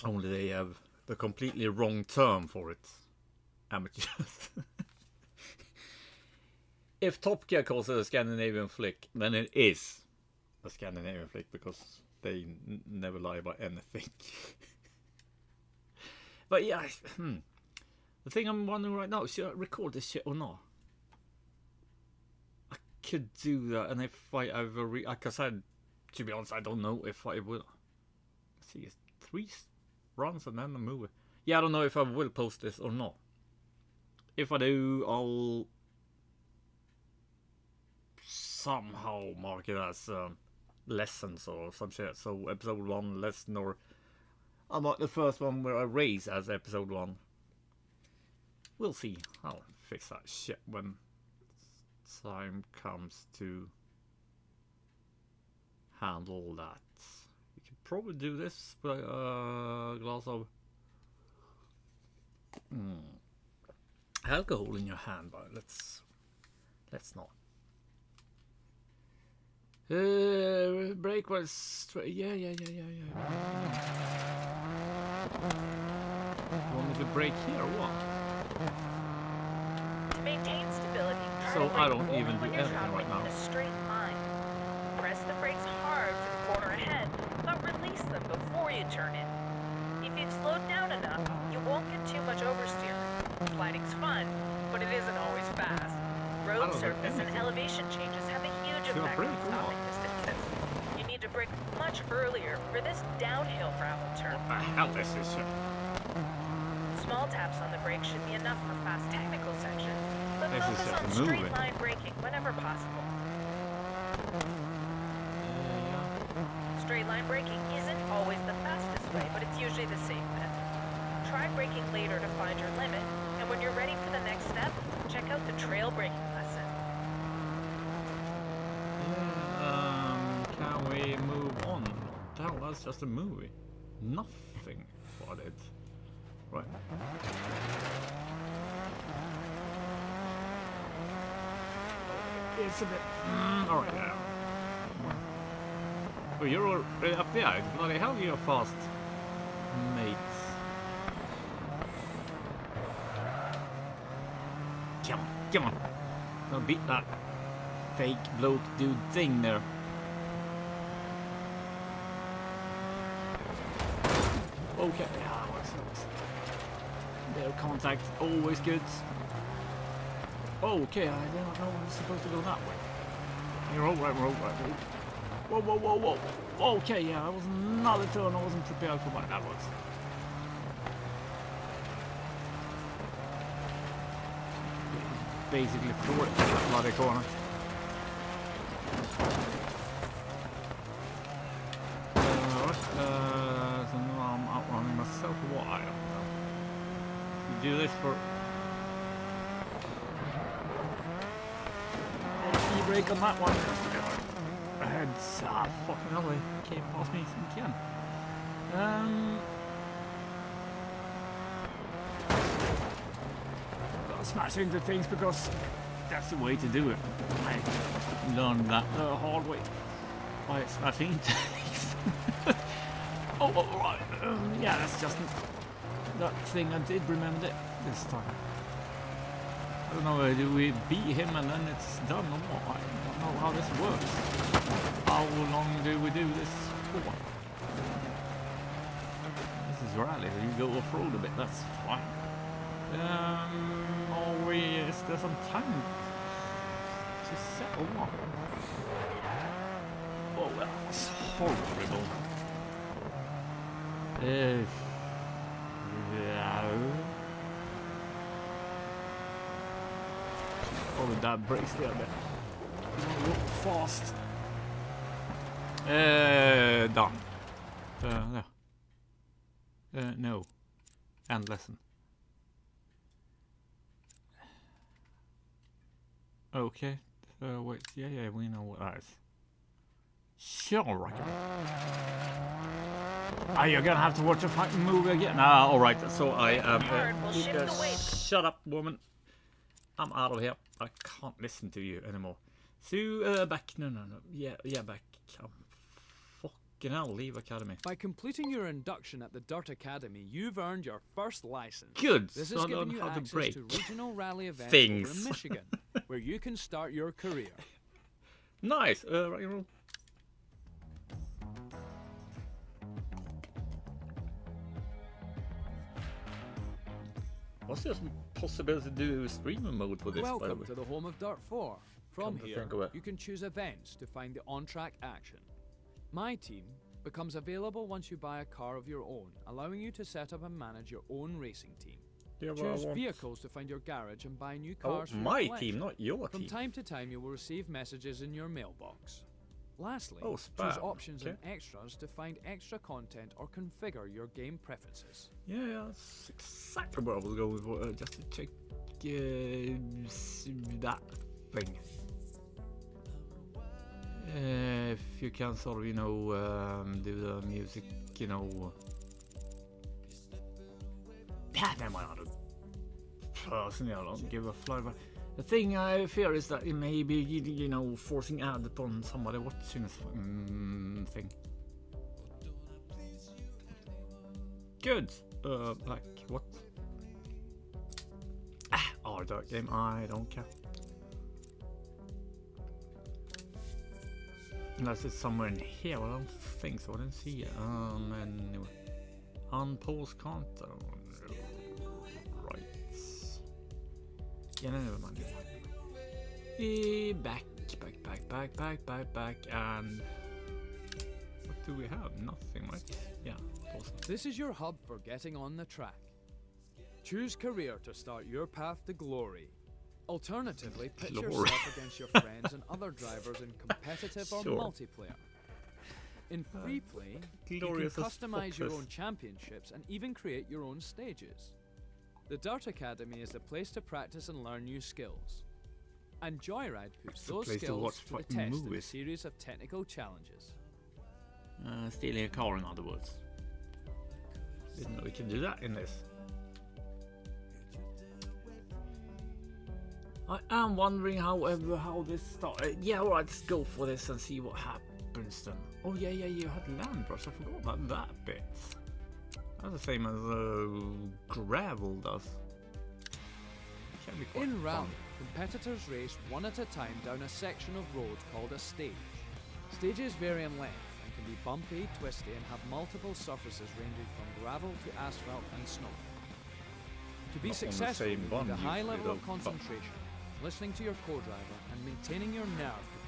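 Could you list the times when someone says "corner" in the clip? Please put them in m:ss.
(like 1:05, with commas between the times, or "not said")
1:26, 3:06.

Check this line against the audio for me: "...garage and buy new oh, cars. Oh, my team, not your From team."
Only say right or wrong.
right.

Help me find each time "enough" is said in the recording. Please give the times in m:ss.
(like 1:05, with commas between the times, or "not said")
1:30, 1:48.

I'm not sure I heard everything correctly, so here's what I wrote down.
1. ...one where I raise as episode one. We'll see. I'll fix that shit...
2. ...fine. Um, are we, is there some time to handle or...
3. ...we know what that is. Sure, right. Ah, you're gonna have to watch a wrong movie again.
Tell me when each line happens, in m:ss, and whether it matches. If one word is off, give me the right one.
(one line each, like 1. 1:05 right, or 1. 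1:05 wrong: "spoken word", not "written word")
1. 0:45 right
2. 4:01 wrong: "settle", not "handle"
3. 4:38 wrong: "fucking", not "wrong".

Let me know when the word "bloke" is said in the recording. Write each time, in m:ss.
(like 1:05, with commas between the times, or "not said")
2:38.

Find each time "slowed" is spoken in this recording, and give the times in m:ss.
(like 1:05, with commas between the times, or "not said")
1:30.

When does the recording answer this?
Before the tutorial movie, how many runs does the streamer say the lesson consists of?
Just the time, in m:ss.
0:29.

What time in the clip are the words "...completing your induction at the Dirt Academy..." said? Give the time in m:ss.
4:57.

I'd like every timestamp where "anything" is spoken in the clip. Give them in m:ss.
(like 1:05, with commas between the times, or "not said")
0:13, 1:22.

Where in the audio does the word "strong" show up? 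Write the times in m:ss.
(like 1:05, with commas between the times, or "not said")
not said.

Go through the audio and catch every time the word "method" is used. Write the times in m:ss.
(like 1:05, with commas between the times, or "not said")
2:00.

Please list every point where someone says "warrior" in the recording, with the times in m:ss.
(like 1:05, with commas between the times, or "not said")
not said.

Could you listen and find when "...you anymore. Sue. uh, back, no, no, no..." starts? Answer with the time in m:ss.
4:51.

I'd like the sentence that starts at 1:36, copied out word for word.
Road surface and elevation changes have pretty cool.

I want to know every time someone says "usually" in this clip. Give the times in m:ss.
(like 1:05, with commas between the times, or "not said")
1:59.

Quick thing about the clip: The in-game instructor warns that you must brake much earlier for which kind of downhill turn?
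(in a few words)
Gravel turn.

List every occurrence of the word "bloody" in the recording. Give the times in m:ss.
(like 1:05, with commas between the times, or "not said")
2:27, 3:06.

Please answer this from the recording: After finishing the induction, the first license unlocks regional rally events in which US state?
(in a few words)
Michigan.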